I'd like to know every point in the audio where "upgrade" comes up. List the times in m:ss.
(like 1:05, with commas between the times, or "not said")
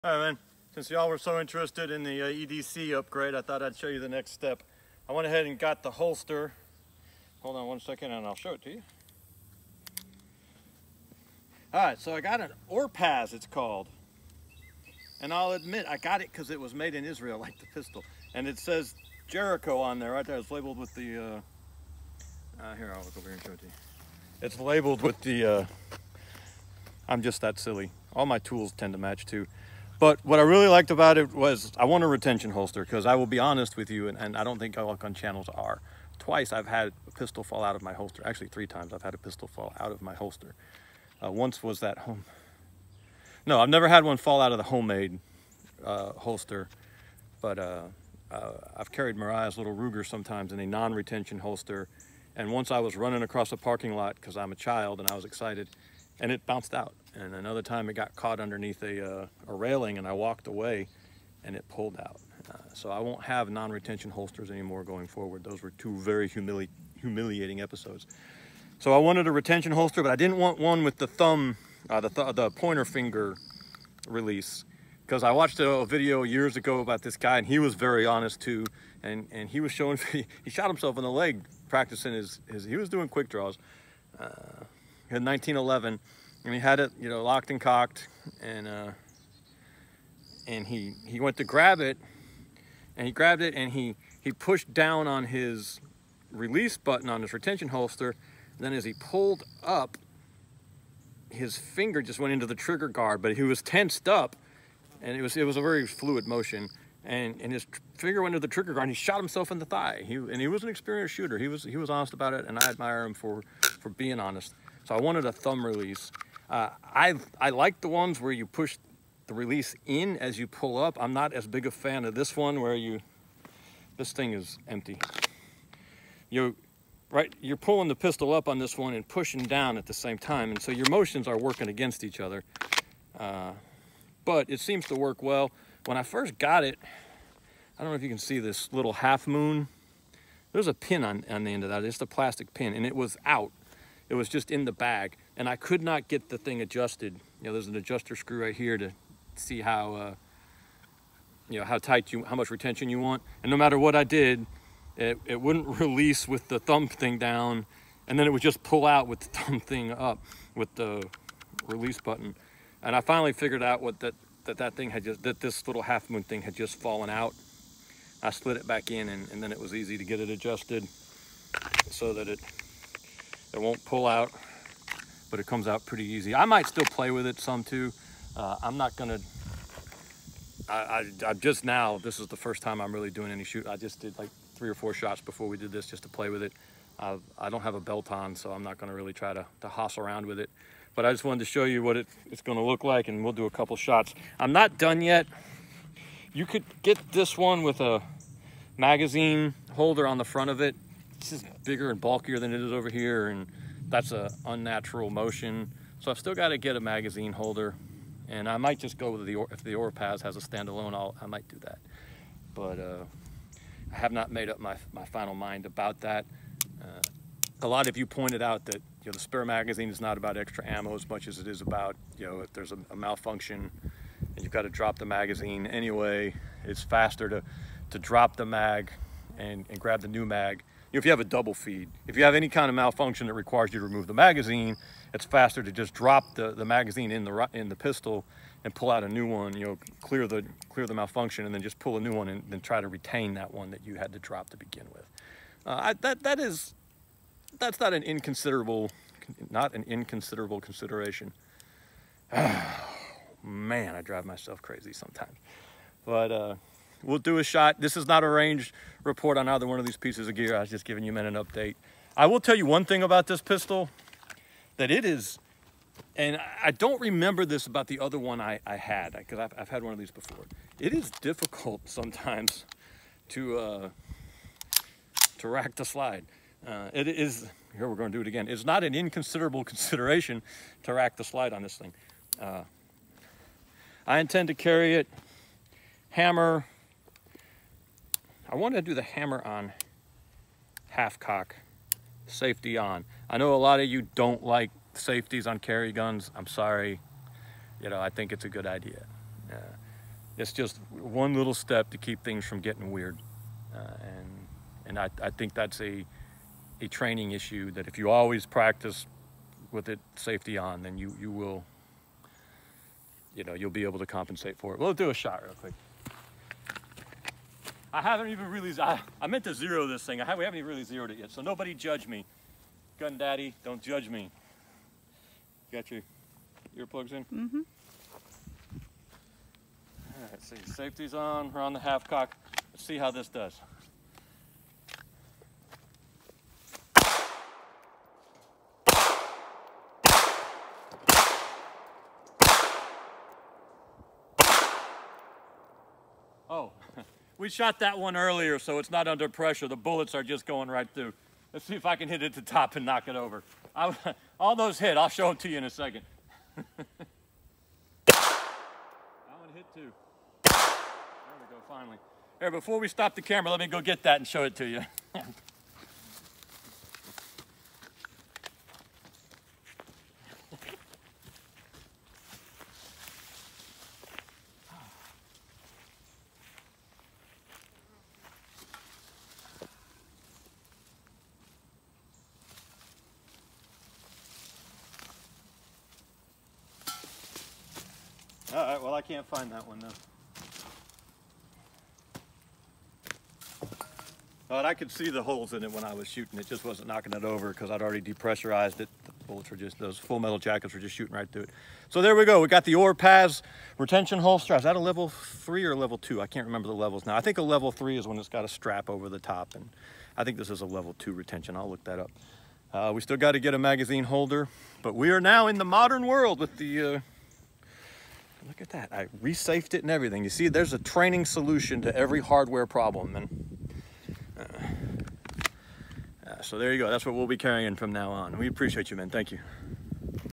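0:02.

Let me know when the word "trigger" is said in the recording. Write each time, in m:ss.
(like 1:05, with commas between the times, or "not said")
1:42, 1:48.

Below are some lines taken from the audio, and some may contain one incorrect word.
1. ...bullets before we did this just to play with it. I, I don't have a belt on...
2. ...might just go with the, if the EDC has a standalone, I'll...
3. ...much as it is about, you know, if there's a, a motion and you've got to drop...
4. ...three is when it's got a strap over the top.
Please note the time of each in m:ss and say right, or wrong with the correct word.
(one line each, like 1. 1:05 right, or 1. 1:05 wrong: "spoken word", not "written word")
1. 3:04 wrong: "shots", not "bullets"
2. 3:28 wrong: "Orpaz", not "EDC"
3. 3:41 wrong: "malfunction", not "motion"
4. 6:47 right.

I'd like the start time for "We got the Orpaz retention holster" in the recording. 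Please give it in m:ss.
6:42.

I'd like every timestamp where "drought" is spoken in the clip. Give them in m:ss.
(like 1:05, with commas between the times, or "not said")
not said.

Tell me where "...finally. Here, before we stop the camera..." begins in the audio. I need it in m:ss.
6:01.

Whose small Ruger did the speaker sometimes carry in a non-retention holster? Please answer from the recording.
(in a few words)
Mariah's.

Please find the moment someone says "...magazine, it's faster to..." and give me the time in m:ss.
3:54.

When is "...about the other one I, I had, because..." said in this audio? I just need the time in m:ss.
4:27.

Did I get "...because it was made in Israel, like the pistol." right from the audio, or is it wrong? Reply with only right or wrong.
right.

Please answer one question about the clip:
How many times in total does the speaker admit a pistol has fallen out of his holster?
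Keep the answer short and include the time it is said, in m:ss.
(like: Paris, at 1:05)
3, at 0:38.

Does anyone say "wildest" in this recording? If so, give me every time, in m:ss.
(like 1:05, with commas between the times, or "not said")
not said.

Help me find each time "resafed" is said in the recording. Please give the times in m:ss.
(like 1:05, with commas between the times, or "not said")
6:59.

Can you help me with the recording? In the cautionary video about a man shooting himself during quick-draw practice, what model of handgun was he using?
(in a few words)
1911.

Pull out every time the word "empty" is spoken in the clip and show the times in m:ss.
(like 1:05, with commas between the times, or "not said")
2:04.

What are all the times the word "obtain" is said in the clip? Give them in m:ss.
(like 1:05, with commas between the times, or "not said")
not said.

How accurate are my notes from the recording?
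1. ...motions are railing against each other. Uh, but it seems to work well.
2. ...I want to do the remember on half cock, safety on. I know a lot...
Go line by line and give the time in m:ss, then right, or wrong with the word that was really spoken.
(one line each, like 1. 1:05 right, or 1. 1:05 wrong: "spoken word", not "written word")
1. 2:10 wrong: "working", not "railing"
2. 4:48 wrong: "hammer", not "remember".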